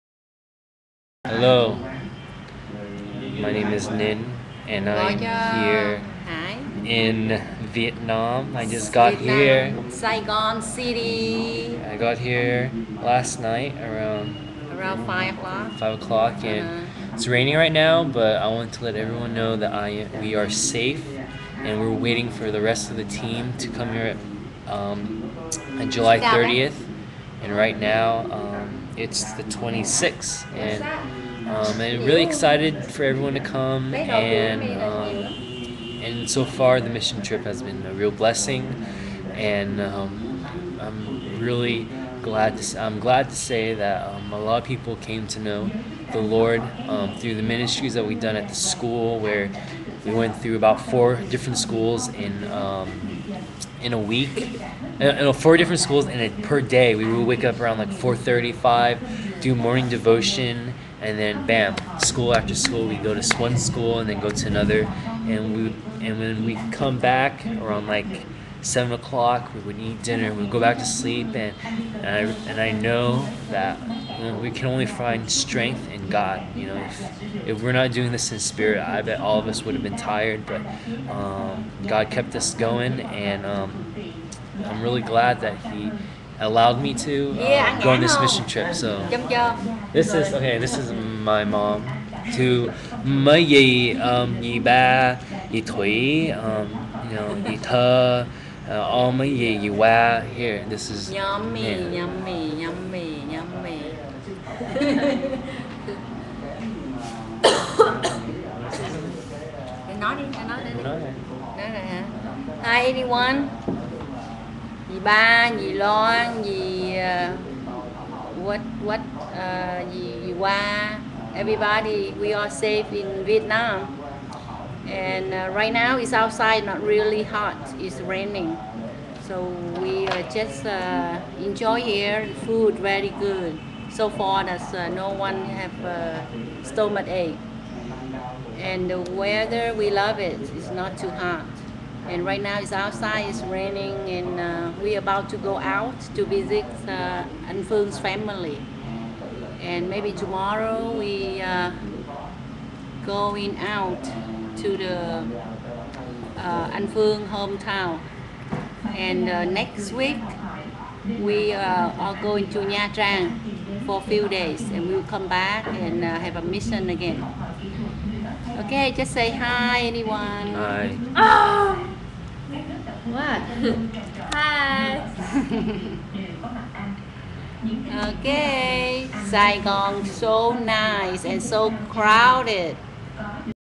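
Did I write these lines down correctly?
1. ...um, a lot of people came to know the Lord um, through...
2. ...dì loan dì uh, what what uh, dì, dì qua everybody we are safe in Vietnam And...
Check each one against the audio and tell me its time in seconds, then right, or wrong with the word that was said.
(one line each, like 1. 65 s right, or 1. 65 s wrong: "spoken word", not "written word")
1. 44 s right
2. 115 s right.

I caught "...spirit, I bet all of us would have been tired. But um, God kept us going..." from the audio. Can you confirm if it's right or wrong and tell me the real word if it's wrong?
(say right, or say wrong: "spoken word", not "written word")
right.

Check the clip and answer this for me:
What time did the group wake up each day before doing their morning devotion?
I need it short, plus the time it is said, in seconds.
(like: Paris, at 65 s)
4:35, at 57 s.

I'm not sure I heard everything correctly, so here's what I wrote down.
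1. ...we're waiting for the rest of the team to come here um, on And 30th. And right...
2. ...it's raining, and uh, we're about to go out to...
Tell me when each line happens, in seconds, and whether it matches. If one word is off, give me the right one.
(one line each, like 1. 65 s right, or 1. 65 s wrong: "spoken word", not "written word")
1. 21 s wrong: "July", not "And"
2. 143 s right.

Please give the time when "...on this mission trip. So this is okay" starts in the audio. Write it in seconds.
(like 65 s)
87 s.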